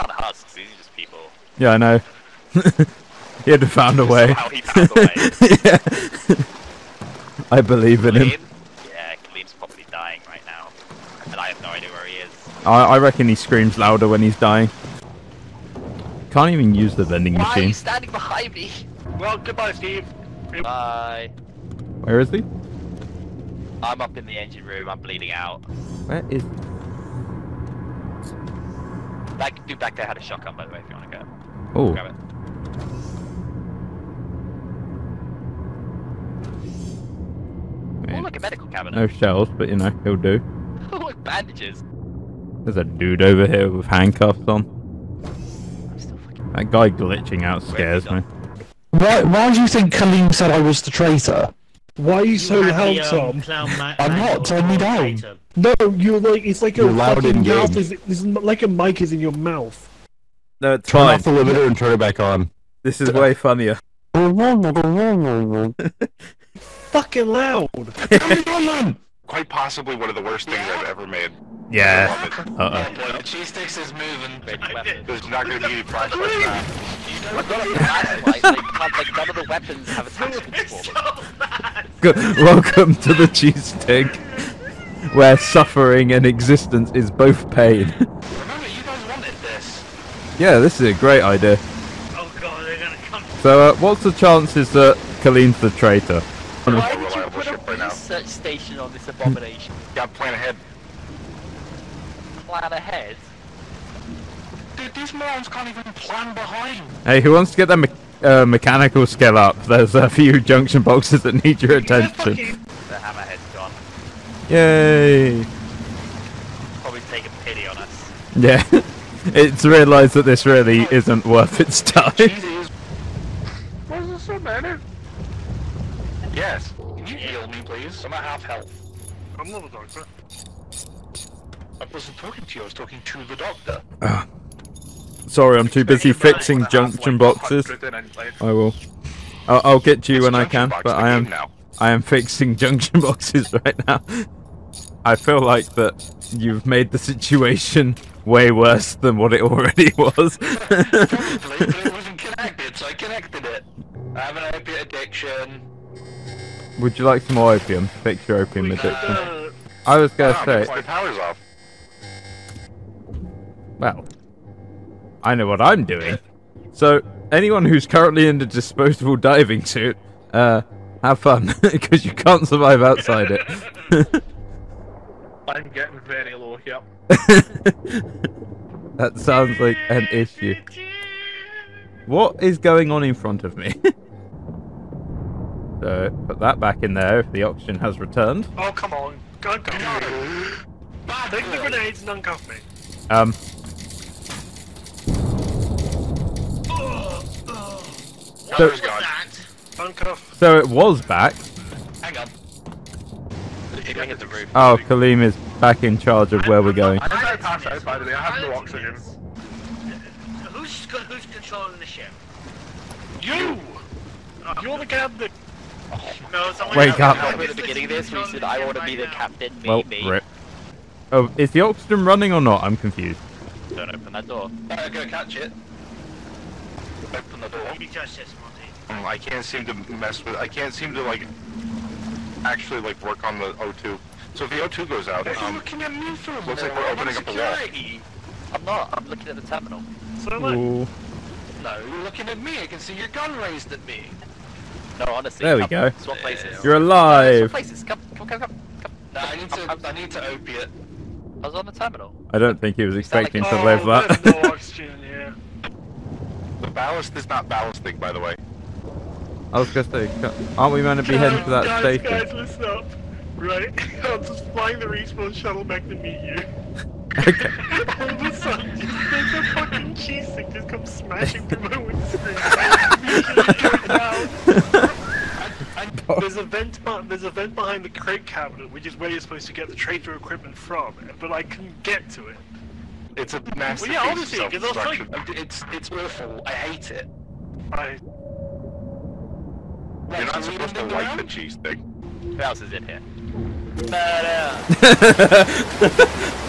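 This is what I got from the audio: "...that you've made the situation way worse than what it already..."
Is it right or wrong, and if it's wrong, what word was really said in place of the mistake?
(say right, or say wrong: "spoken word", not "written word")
right.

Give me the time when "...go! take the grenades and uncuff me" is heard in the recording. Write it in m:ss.
3:09.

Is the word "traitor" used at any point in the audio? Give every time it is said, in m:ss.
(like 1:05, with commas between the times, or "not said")
0:50, 1:35.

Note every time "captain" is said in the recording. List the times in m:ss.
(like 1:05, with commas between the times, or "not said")
3:34, 3:39.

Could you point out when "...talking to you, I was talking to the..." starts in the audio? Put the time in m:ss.
2:12.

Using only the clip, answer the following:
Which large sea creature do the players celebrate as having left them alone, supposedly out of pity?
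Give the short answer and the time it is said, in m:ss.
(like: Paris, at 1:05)
hammerhead, at 1:52.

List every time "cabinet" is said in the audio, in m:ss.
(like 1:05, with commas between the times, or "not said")
0:38, 4:38.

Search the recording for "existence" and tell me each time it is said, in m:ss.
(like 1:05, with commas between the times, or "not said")
1:26.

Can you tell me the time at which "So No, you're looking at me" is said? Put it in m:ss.
4:00.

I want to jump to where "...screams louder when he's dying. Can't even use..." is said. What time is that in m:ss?
0:13.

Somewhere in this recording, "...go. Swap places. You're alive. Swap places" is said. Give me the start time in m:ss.
4:05.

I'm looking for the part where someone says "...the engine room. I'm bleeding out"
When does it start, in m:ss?
0:24.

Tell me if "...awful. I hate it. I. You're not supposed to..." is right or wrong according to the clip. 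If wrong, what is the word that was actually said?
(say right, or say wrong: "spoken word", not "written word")
right.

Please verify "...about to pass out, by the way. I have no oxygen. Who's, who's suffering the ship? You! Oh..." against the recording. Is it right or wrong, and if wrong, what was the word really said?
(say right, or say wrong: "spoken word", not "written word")
wrong: "controlling", not "suffering".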